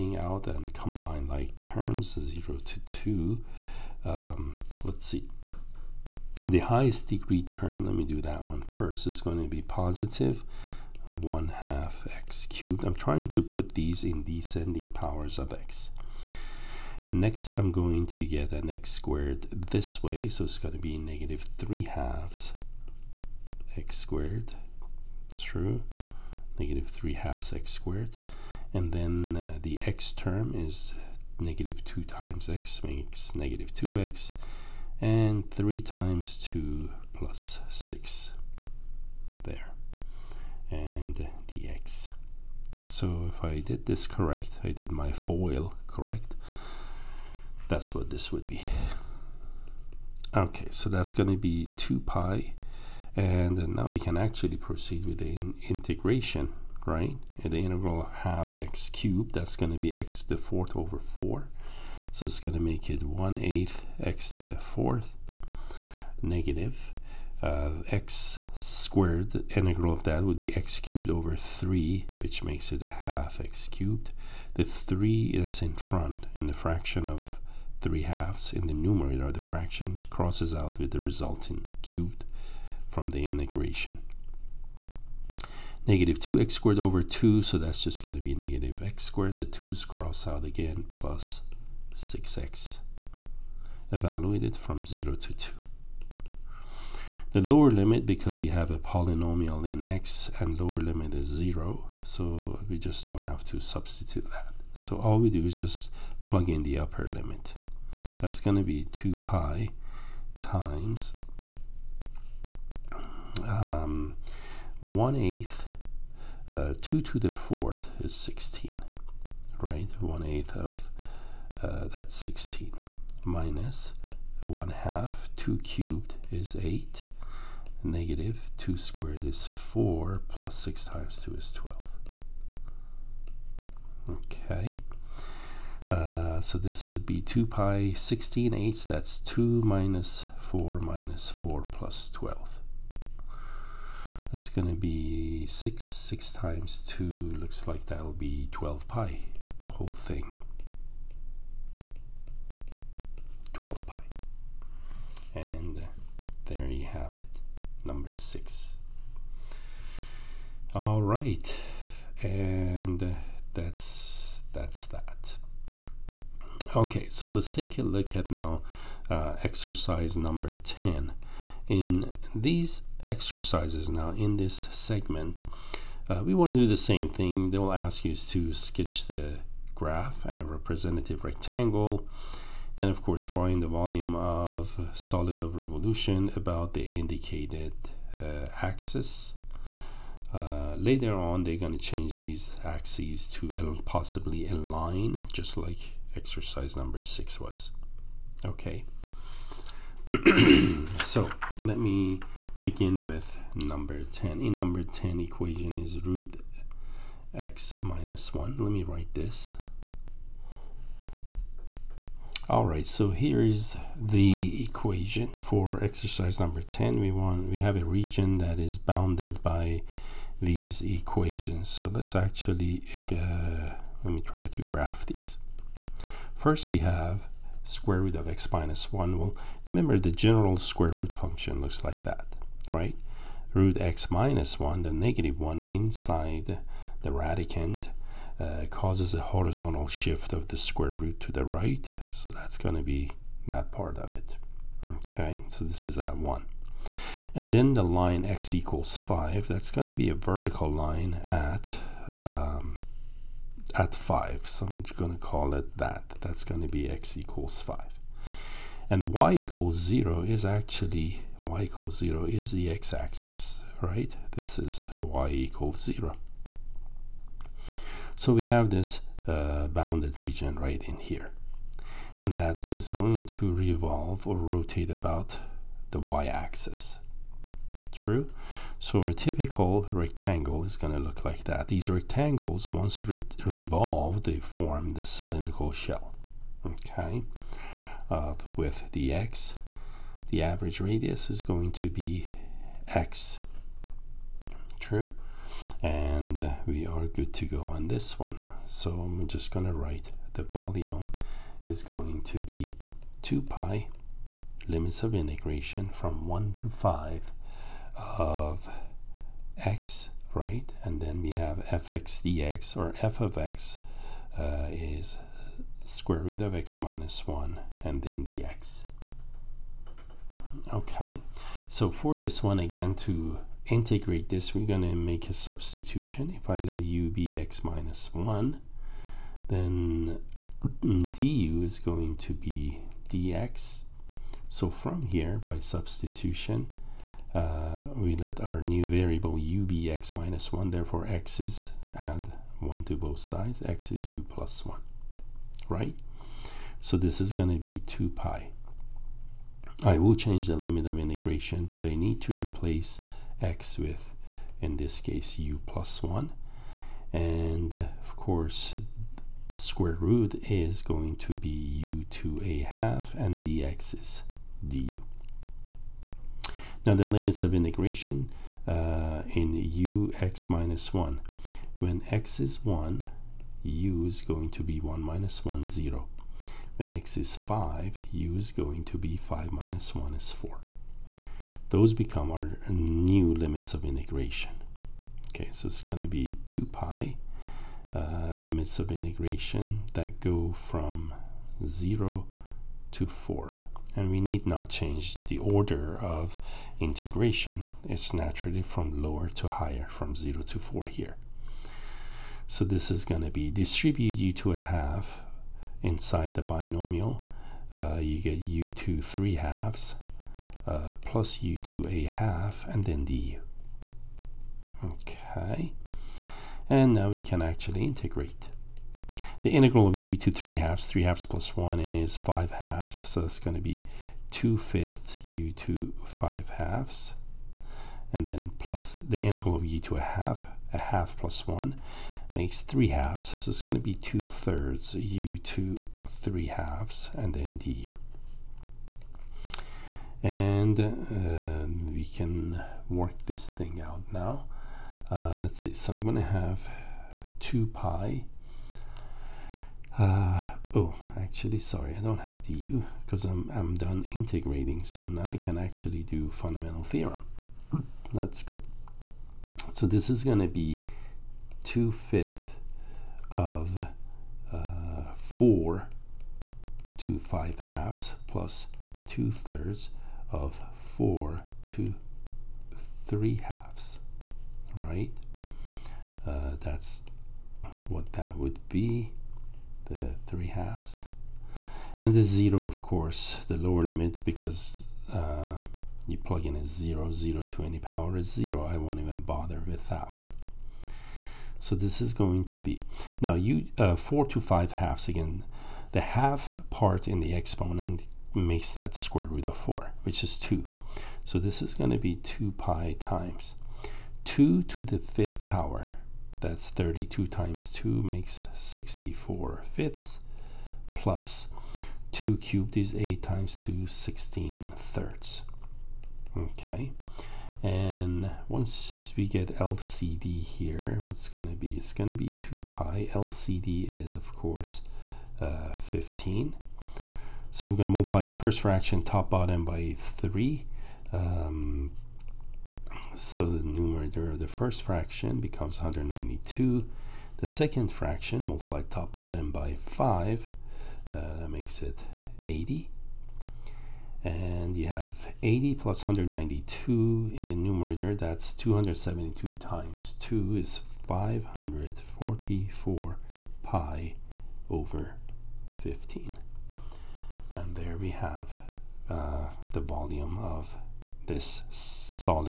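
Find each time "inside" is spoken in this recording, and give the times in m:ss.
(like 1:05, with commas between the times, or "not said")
3:55, 6:45.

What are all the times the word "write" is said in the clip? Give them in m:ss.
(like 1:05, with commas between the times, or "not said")
3:28, 4:59.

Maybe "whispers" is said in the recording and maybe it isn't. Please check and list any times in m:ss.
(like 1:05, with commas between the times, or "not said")
not said.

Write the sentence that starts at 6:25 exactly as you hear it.
Okay, so it's going to be 2 pi uh, limits of integration that go from 0 to 4.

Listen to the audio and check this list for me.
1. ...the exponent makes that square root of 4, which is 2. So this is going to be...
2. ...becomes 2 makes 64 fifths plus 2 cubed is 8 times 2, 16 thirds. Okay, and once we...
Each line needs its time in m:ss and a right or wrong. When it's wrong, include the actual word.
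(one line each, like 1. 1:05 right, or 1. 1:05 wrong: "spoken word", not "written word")
1. 8:17 right
2. 8:27 wrong: "times", not "becomes".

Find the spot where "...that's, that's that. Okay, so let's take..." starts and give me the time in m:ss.
2:43.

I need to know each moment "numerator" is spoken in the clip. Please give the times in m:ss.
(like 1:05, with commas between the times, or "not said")
1:18, 8:53, 9:07.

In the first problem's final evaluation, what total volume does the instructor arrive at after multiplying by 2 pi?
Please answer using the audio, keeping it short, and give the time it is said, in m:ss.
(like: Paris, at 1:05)
12 pi, at 2:28.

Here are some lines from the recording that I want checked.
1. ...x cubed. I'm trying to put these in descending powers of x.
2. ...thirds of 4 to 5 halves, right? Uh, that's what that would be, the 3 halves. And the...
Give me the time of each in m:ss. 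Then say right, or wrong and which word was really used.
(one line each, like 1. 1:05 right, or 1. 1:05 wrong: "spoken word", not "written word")
1. 0:12 right
2. 7:49 wrong: "3", not "5".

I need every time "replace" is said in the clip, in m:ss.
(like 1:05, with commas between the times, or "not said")
5:52.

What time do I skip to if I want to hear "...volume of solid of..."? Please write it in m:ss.
3:03.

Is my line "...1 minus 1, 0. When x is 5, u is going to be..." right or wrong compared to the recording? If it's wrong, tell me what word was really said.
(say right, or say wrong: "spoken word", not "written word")
right.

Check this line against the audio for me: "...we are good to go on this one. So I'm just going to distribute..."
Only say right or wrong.
wrong.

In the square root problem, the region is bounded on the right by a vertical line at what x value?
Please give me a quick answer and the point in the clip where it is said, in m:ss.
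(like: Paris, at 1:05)
5, at 4:13.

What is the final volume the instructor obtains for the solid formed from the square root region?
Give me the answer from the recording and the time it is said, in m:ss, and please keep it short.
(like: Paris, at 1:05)
544 pi/15, at 9:11.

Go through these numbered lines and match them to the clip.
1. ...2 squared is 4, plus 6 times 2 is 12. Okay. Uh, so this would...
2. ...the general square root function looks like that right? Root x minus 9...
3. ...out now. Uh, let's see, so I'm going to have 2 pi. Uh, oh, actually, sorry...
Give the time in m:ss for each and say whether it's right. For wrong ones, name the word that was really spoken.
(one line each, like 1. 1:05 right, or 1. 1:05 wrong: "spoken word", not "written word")
1. 2:08 right
2. 3:49 wrong: "1", not "9"
3. 7:23 right.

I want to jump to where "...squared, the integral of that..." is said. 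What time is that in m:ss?
1:08.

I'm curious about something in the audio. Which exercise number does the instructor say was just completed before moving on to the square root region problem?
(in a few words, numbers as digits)
6.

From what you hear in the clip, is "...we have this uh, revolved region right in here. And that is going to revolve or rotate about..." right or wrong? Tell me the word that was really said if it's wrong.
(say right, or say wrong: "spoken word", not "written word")
wrong: "bounded", not "revolved".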